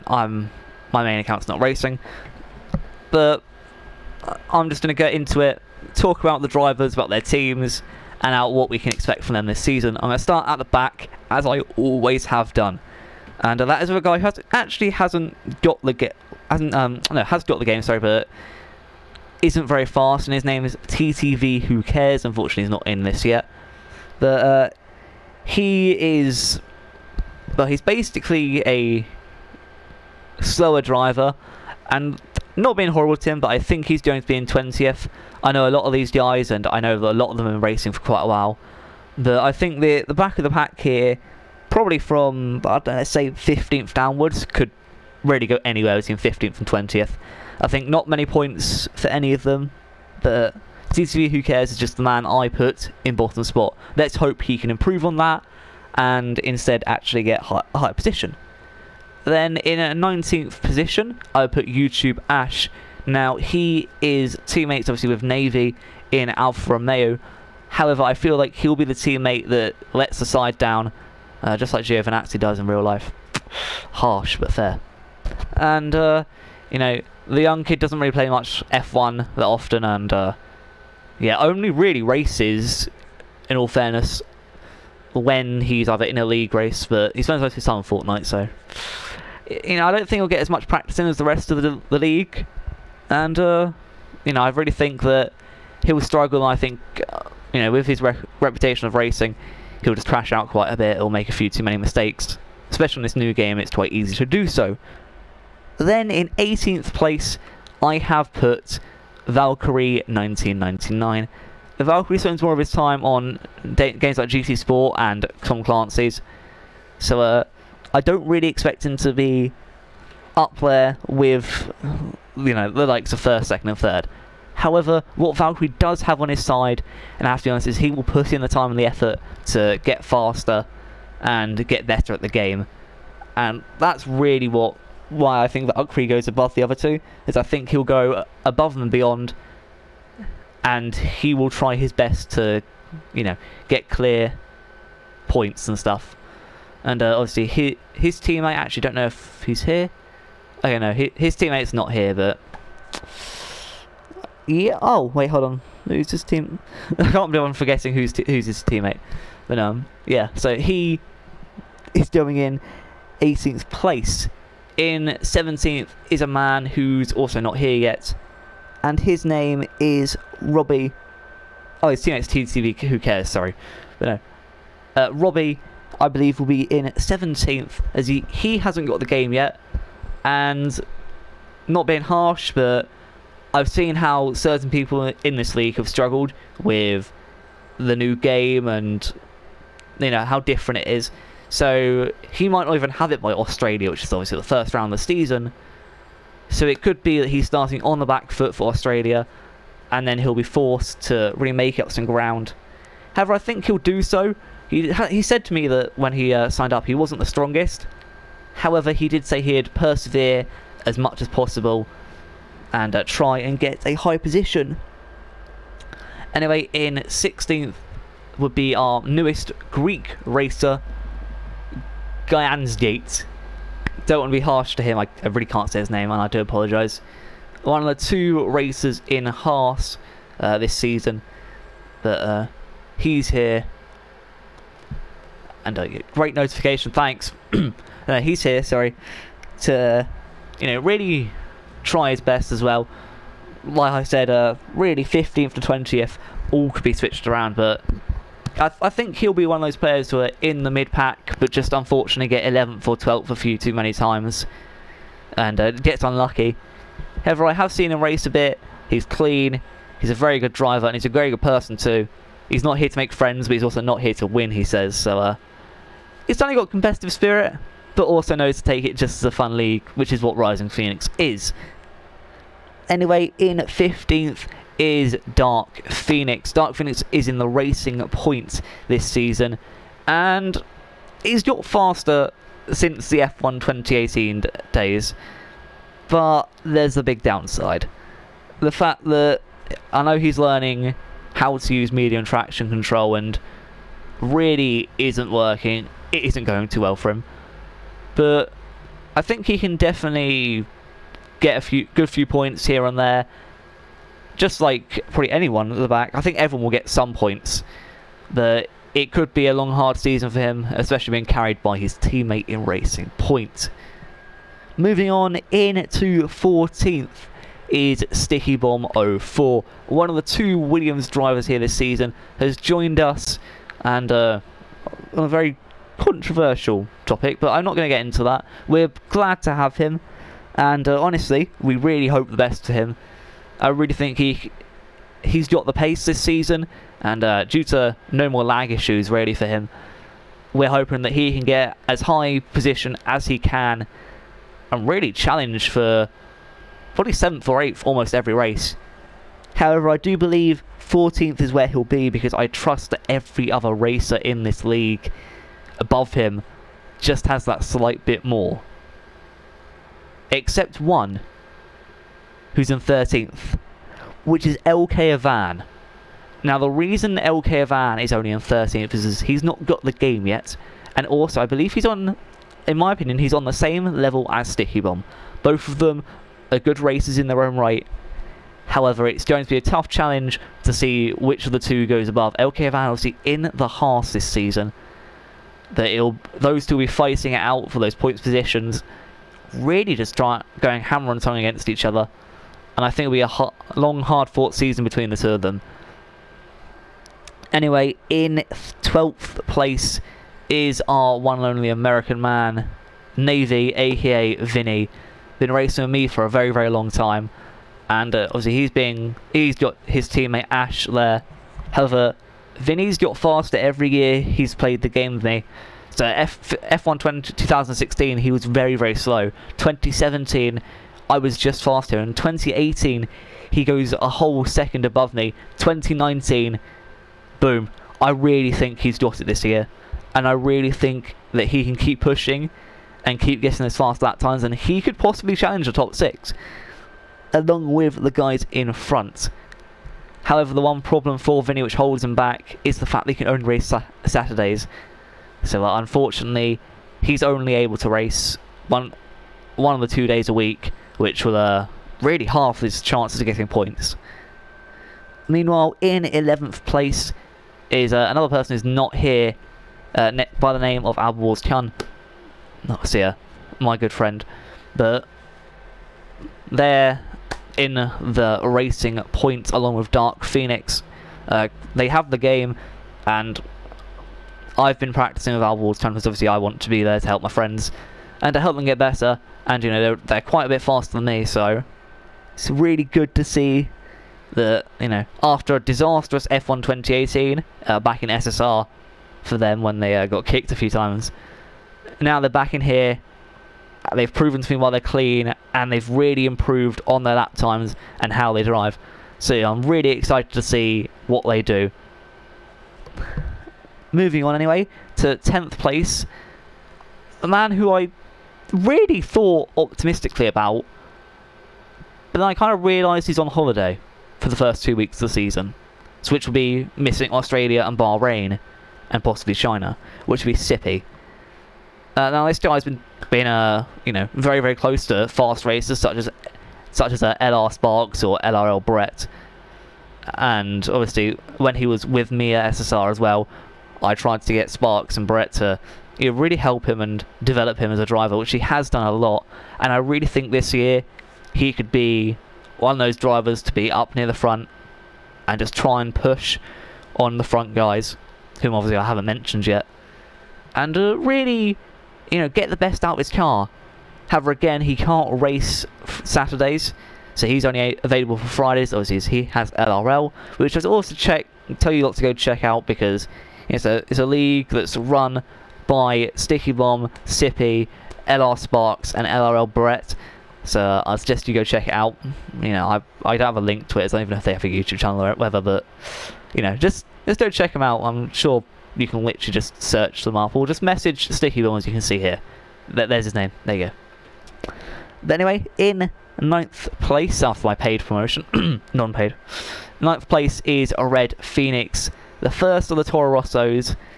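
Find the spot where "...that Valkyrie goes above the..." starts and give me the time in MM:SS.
02:15.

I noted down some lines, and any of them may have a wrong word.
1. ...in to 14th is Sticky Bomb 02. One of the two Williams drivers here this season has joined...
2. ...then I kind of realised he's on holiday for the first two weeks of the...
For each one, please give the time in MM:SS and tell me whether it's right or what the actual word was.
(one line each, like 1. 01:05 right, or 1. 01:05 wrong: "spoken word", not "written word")
1. 05:15 wrong: "04", not "02"
2. 08:32 right.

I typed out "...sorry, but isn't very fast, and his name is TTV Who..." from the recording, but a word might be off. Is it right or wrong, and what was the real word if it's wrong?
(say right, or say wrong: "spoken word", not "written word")
right.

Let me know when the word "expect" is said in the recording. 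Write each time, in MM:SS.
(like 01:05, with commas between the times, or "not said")
00:08, 01:58.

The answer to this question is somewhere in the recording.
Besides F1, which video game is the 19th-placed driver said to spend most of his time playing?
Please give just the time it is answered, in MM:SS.
01:27.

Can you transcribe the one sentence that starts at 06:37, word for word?
Anyway, in twelfth place is our one and only American man, Navy, aka Vinny.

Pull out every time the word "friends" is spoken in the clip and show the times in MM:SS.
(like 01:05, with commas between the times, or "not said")
04:23, 07:43, 07:57.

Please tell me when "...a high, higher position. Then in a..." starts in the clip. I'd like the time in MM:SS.
00:57.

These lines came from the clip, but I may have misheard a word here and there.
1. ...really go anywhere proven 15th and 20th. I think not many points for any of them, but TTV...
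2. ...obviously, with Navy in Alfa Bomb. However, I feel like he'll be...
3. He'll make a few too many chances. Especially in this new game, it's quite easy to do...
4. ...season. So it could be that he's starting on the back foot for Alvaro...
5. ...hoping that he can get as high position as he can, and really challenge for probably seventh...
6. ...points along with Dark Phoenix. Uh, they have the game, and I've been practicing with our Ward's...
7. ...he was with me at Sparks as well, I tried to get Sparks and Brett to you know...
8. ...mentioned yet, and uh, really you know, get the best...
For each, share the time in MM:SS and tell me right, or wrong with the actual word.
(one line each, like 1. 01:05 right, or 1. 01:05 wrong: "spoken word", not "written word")
1. 00:45 wrong: "between", not "proven"
2. 01:04 wrong: "Romeo", not "Bomb"
3. 01:40 wrong: "mistakes", not "chances"
4. 03:15 wrong: "Australia", not "Alvaro"
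5. 05:40 right
6. 07:49 right
7. 08:51 wrong: "SSR", not "Sparks"
8. 09:09 right.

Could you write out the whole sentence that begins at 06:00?
Except one, who's in 13th, which is LK Avan.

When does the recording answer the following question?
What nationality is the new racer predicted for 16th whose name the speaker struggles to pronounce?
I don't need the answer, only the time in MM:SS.
03:39.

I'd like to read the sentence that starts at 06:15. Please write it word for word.
Both of them are good racers in their own right.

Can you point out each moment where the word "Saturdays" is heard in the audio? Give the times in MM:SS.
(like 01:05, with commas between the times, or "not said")
07:24, 09:16.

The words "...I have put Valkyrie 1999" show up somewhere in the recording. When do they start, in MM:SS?
01:47.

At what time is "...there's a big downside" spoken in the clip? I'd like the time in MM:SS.
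04:46.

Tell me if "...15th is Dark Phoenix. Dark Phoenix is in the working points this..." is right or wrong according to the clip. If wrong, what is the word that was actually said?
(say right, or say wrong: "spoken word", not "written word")
wrong: "racing", not "working".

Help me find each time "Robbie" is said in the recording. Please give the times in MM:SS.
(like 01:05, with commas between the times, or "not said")
02:50, 02:55.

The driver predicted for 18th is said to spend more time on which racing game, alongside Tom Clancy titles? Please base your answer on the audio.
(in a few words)
GT Sport.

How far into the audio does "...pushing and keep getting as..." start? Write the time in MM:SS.
07:12.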